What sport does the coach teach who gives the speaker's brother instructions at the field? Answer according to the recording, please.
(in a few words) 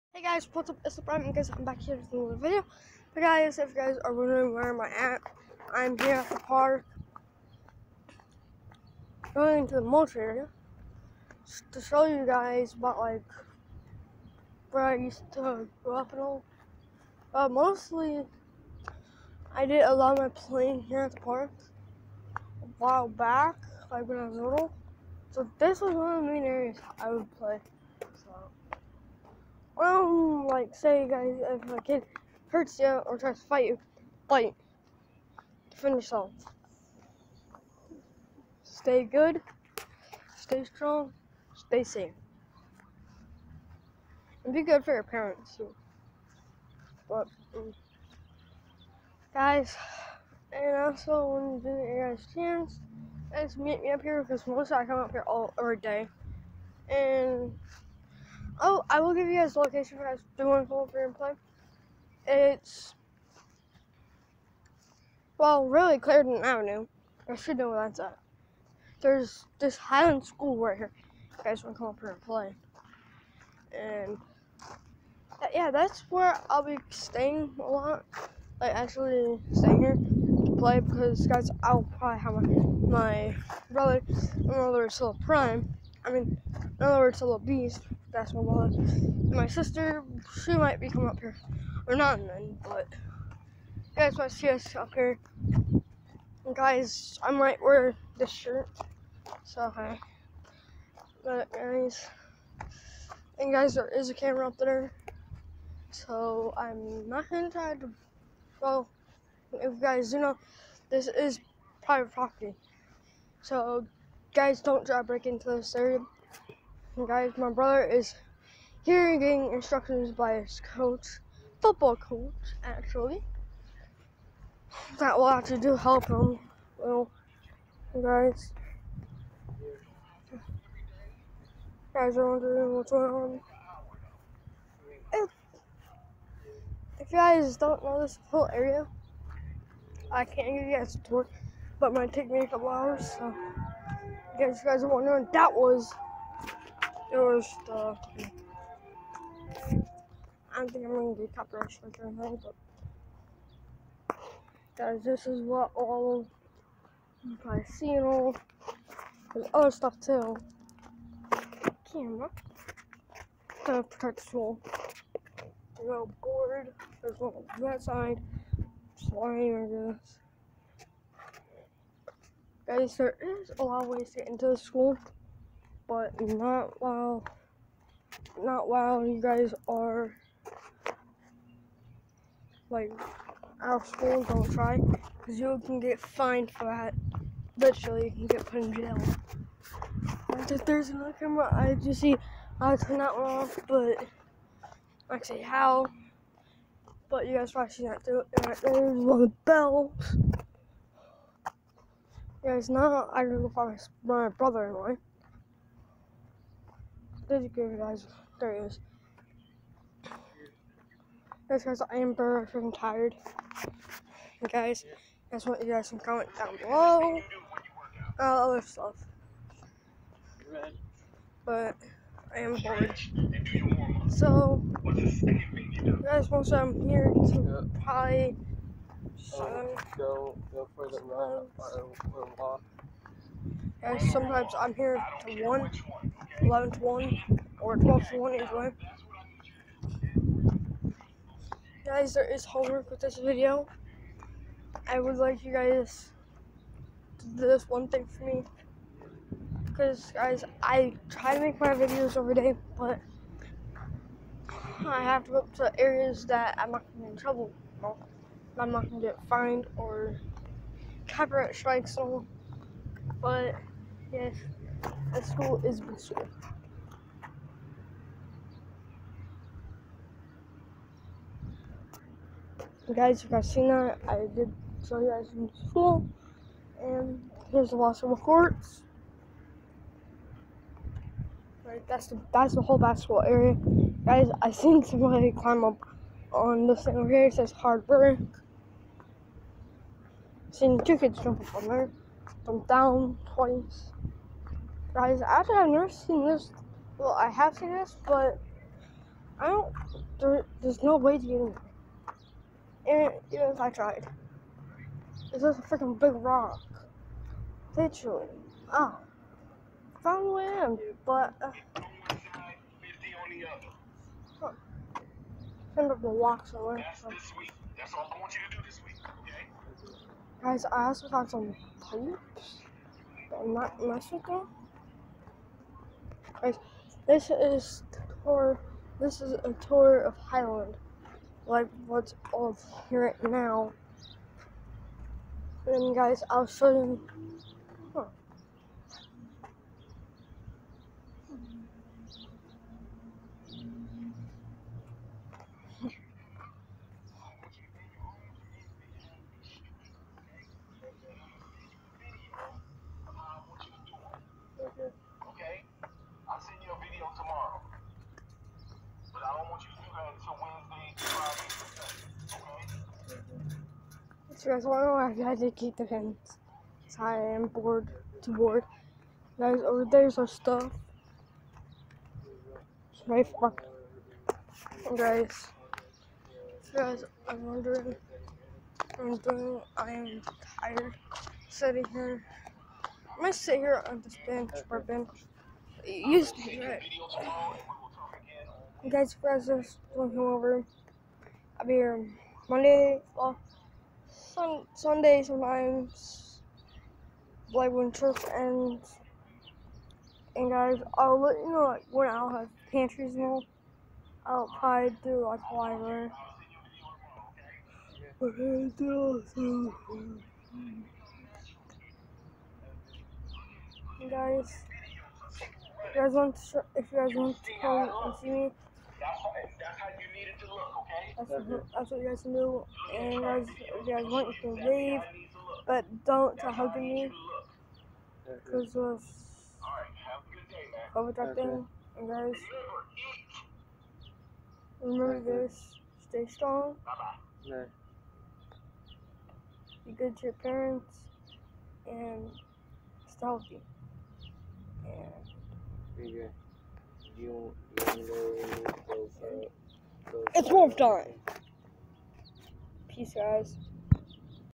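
Football.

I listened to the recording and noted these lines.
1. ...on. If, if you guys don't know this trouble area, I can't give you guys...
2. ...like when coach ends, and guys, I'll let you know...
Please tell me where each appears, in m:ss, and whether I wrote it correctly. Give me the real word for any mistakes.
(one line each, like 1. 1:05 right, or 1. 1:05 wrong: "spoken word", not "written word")
1. 2:13 wrong: "whole", not "trouble"
2. 6:37 wrong: "church", not "coach".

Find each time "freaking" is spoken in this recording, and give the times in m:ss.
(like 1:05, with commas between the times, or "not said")
3:32, 5:05.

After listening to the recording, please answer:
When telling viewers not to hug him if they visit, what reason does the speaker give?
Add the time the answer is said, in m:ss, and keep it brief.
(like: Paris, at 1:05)
COVID, at 7:10.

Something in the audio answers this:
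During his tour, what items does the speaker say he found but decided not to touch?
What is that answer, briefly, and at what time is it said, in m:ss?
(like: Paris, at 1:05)
Pipes, at 5:21.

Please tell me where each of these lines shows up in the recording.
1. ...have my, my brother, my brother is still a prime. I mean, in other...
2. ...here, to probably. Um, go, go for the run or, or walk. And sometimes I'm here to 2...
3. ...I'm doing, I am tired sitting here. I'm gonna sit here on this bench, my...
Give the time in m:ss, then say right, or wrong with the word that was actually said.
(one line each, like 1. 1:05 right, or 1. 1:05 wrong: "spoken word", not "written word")
1. 1:22 right
2. 3:46 wrong: "1", not "2"
3. 6:18 right.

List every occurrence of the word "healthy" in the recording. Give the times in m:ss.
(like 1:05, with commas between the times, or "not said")
7:23.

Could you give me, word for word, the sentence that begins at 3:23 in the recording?
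I don't know go find my, my brother in law there you guys.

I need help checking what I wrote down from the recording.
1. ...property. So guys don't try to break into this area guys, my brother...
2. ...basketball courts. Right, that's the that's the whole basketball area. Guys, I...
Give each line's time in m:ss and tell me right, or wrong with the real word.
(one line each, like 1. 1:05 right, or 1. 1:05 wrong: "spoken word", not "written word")
1. 1:52 right
2. 4:37 right.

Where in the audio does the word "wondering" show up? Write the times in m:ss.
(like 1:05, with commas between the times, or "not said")
0:04, 2:12, 2:24, 6:17.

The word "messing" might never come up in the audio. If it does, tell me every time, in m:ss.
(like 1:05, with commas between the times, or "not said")
5:23.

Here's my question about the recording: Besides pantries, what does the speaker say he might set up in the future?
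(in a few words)
A library.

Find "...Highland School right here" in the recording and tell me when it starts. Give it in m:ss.
1:09.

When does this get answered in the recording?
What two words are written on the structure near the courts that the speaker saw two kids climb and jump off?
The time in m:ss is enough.
4:47.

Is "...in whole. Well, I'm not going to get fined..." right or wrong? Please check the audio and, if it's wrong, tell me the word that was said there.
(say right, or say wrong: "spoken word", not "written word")
wrong: "trouble", not "whole".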